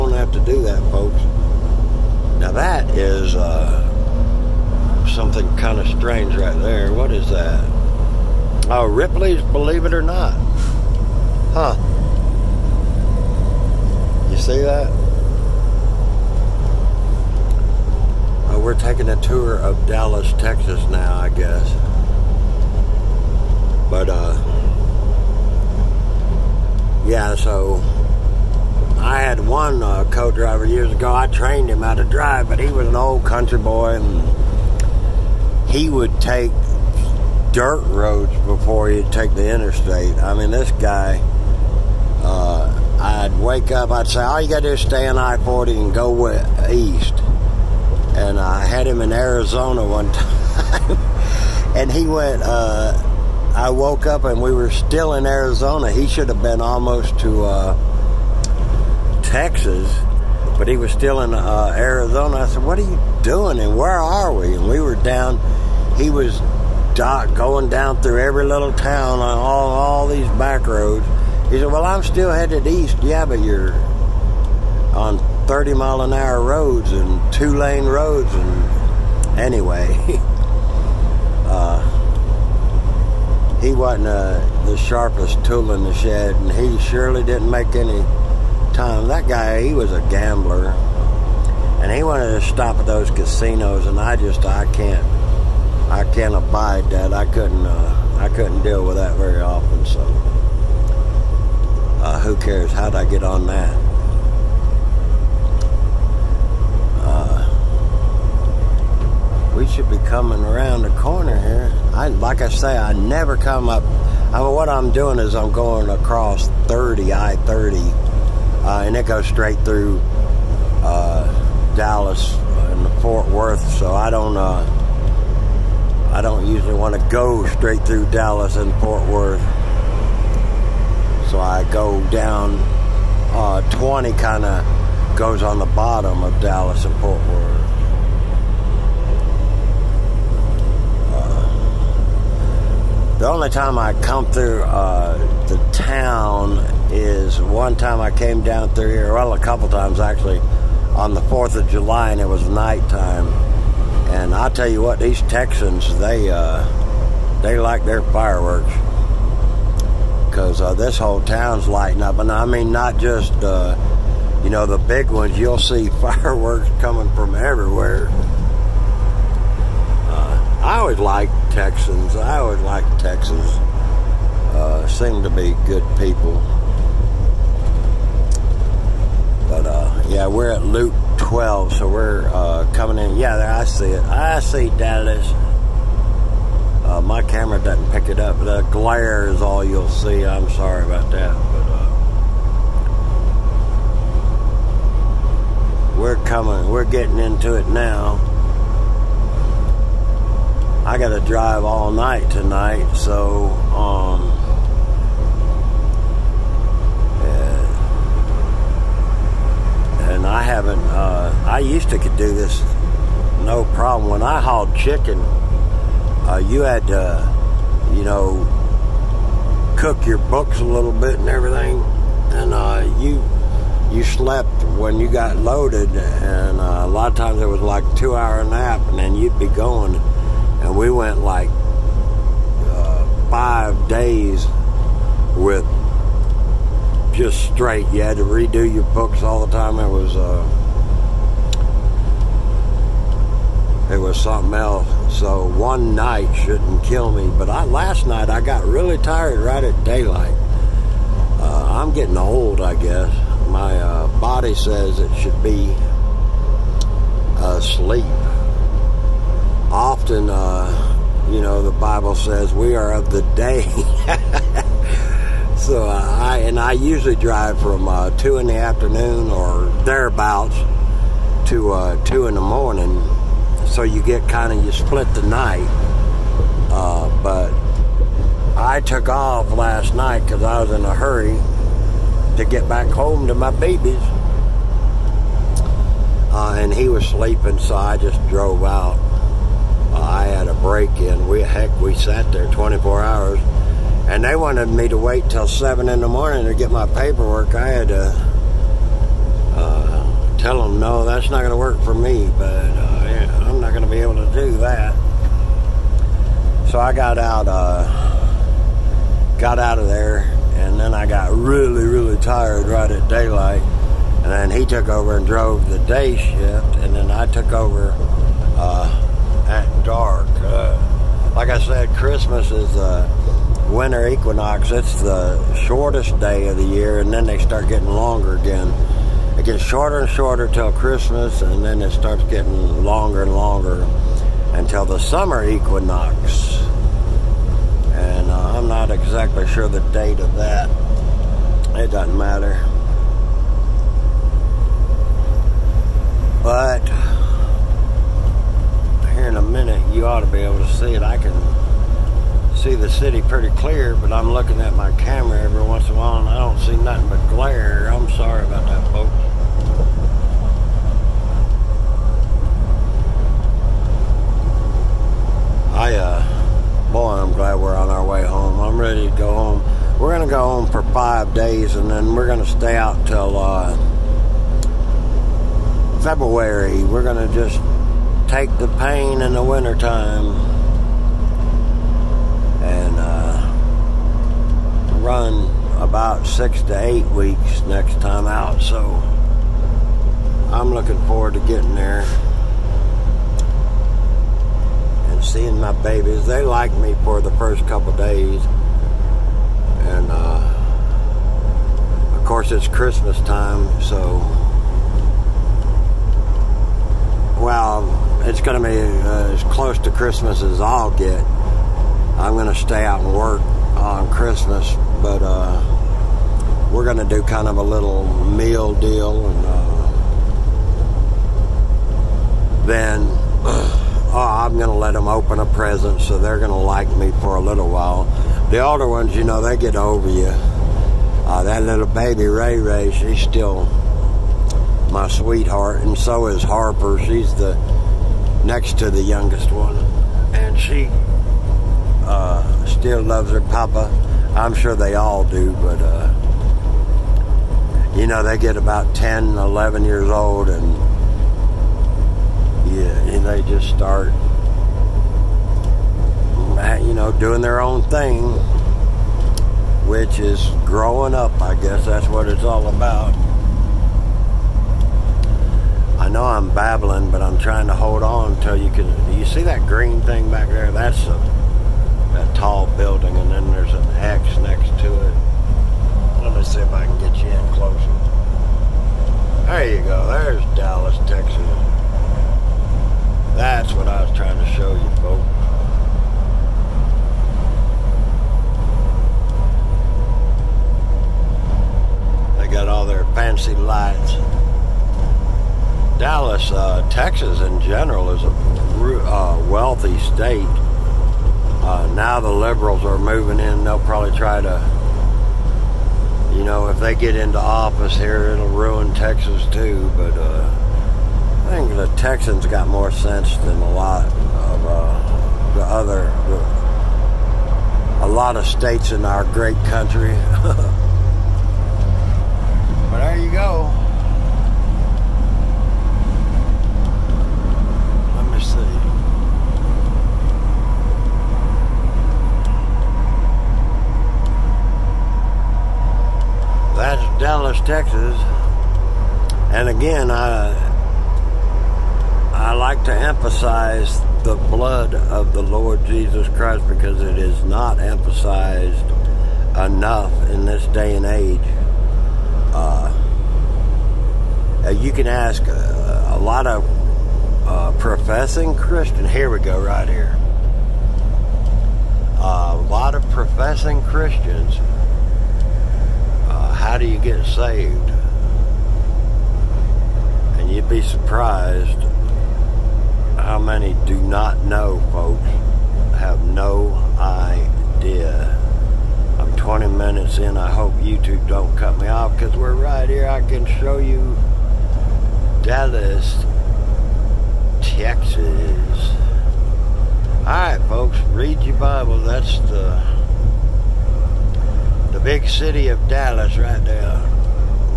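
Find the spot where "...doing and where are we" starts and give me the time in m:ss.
1:03.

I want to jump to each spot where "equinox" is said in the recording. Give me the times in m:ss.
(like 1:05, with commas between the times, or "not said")
5:24, 5:35.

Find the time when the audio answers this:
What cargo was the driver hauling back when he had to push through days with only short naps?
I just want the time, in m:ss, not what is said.
3:34.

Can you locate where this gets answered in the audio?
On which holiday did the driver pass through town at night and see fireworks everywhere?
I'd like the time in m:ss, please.
2:31.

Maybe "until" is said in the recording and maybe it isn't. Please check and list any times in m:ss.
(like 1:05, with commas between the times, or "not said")
5:34, 7:48.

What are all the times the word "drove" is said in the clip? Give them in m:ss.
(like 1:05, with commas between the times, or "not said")
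4:48, 5:15.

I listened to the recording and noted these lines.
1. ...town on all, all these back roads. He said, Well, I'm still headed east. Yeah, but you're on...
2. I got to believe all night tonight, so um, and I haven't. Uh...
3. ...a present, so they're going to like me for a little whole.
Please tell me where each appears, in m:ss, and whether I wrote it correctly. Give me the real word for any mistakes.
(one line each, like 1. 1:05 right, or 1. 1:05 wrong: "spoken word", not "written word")
1. 1:08 right
2. 3:20 wrong: "drive", not "believe"
3. 7:05 wrong: "while", not "whole".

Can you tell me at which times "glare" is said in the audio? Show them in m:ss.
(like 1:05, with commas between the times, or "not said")
3:08, 5:57.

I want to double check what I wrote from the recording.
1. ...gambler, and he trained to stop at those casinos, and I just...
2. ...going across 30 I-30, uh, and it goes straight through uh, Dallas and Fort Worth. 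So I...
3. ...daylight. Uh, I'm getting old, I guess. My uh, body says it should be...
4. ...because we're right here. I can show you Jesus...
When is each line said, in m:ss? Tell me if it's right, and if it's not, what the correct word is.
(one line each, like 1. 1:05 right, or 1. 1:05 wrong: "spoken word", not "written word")
1. 1:30 wrong: "wanted", not "trained"
2. 1:55 right
3. 4:09 right
4. 9:42 wrong: "Dallas", not "Jesus".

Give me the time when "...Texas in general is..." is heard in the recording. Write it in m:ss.
8:16.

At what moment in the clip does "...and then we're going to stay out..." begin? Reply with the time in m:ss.
6:11.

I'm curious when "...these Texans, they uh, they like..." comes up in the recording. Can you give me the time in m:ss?
2:34.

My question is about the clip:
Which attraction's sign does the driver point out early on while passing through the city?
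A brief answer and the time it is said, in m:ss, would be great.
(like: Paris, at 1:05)
Ripley's Believe It or Not, at 0:08.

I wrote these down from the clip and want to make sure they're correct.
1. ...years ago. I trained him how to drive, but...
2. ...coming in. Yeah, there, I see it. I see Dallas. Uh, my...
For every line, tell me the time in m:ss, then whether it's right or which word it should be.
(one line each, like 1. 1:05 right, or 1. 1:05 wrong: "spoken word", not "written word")
1. 0:30 right
2. 3:02 right.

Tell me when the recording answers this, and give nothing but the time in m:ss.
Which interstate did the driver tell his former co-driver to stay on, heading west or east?
0:45.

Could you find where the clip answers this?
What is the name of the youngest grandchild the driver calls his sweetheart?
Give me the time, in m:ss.
7:12.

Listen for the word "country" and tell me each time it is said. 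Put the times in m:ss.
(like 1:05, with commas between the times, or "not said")
0:33, 8:39.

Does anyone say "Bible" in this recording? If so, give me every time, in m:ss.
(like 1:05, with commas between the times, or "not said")
4:21, 9:51.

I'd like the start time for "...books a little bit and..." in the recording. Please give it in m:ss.
3:40.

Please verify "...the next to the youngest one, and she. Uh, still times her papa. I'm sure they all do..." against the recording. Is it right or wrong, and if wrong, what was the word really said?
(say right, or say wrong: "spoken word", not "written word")
wrong: "loves", not "times".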